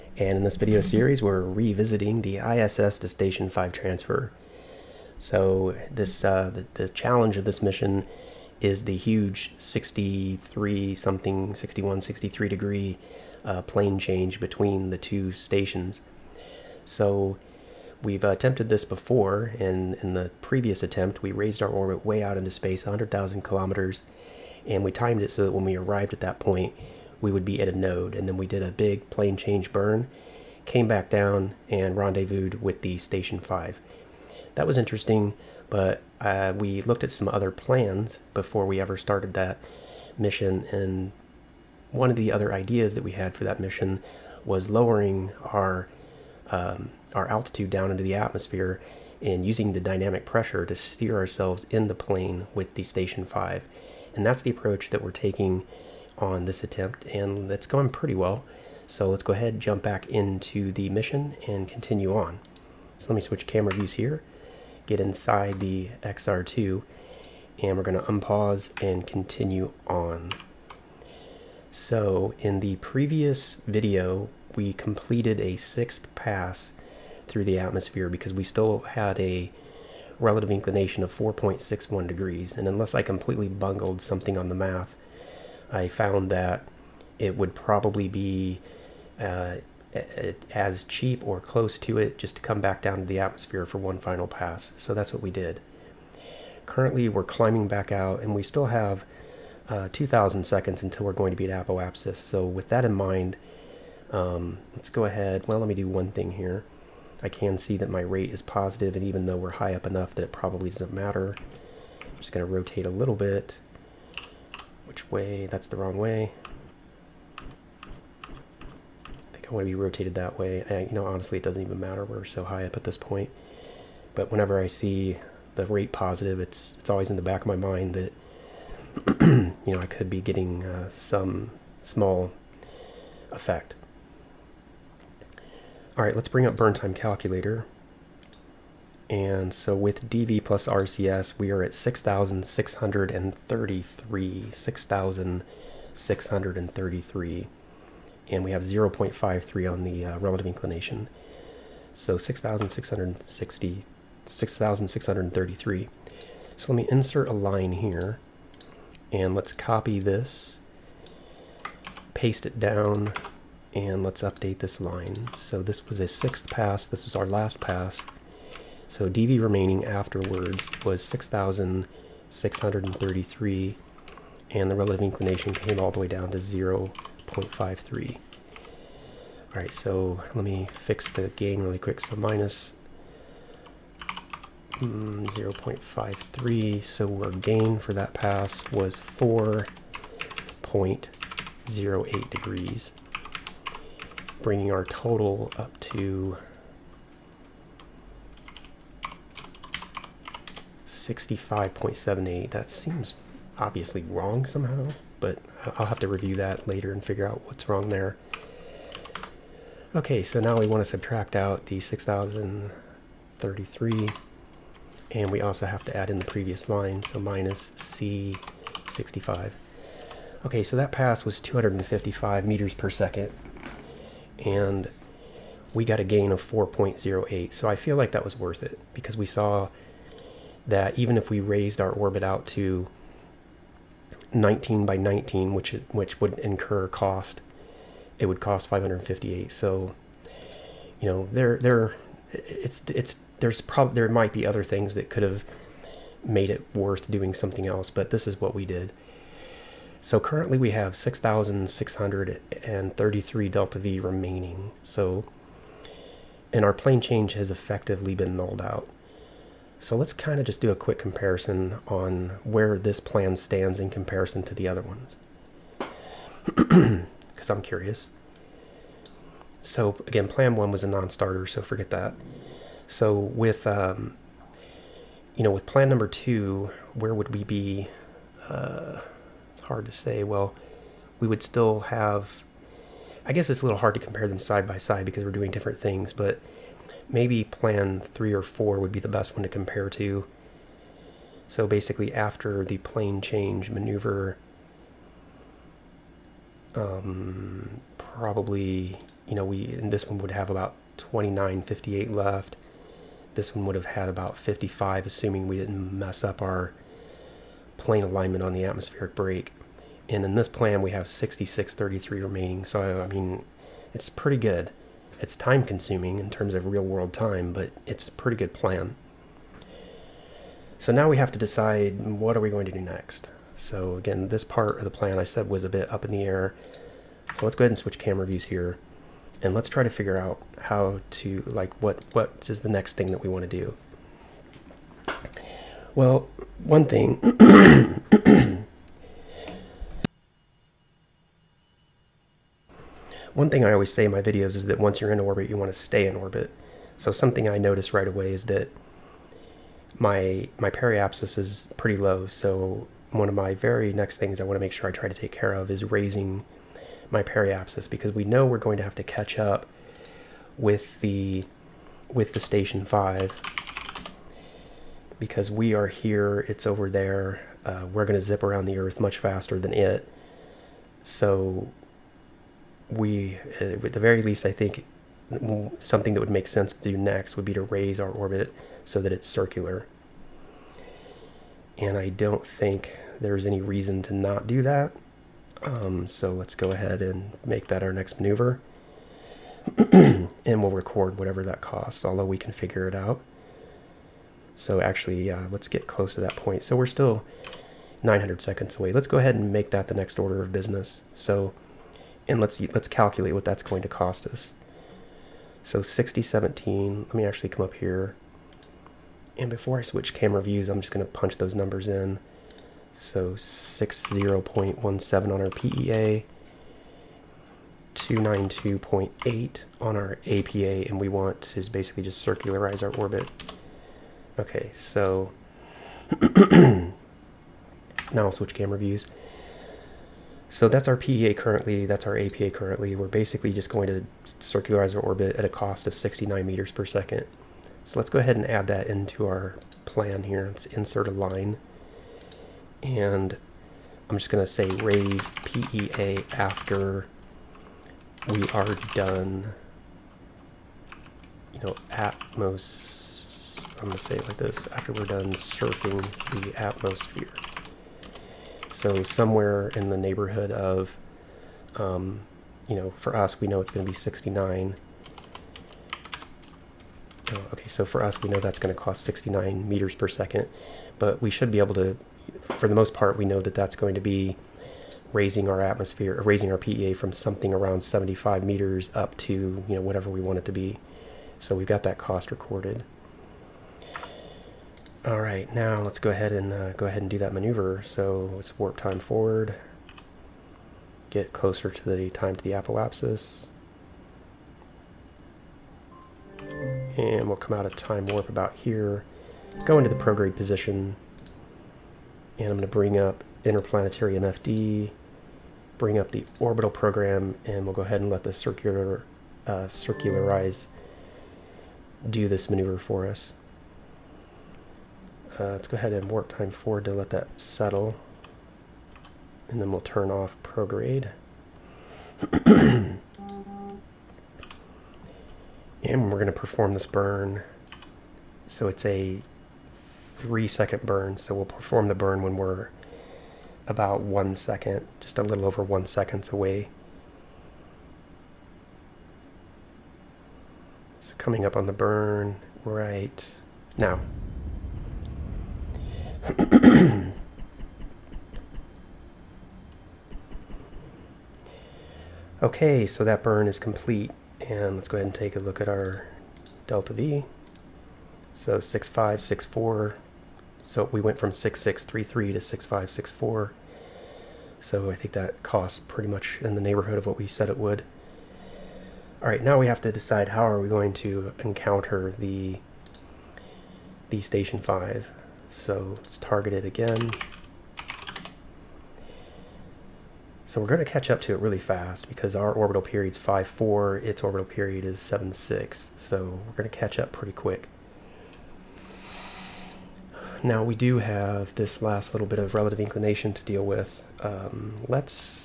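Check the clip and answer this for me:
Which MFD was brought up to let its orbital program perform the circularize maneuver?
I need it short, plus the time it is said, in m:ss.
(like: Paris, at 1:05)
Interplanetary MFD, at 8:23.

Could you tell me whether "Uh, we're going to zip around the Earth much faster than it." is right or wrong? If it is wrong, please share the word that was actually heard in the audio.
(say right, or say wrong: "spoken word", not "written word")
right.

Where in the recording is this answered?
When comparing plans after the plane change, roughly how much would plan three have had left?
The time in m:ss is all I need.
5:00.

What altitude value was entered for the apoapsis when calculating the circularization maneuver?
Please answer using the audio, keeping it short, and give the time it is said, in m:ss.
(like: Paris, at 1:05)
292.8, at 6:57.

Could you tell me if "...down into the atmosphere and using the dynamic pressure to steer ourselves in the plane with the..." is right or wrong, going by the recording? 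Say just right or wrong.
right.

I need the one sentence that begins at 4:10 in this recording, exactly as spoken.
So currently we have 6,633 delta V remaining.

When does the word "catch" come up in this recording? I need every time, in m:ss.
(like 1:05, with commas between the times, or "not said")
5:59, 9:40, 9:46.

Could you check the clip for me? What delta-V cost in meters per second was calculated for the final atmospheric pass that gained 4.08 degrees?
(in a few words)
255 meters per second.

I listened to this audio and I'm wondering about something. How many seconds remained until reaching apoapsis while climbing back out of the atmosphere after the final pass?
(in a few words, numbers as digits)
2,000 seconds.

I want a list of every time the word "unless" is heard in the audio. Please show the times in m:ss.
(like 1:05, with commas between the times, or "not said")
1:22.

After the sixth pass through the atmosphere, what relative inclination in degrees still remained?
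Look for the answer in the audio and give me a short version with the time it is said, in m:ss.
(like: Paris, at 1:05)
4.61 degrees, at 1:21.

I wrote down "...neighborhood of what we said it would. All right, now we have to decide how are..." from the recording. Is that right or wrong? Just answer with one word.
right.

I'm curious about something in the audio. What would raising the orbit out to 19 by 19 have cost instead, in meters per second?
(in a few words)
558.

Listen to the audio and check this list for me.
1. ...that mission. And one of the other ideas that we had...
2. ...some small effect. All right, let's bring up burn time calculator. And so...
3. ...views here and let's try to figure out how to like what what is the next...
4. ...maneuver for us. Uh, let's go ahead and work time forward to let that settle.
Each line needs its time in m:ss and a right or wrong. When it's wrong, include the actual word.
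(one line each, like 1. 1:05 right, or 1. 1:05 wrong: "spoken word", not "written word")
1. 0:39 right
2. 2:10 right
3. 5:28 right
4. 8:32 right.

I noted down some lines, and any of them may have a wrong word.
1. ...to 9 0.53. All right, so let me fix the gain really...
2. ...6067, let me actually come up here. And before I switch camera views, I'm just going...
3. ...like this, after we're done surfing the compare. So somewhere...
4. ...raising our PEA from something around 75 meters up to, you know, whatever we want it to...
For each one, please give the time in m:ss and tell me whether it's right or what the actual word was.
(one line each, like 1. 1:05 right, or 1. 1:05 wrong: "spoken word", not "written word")
1. 2:56 wrong: "0", not "9"
2. 6:45 wrong: "6017", not "6067"
3. 7:34 wrong: "atmosphere", not "compare"
4. 7:56 right.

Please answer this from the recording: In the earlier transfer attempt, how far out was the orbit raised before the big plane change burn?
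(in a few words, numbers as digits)
100,000 kilometers.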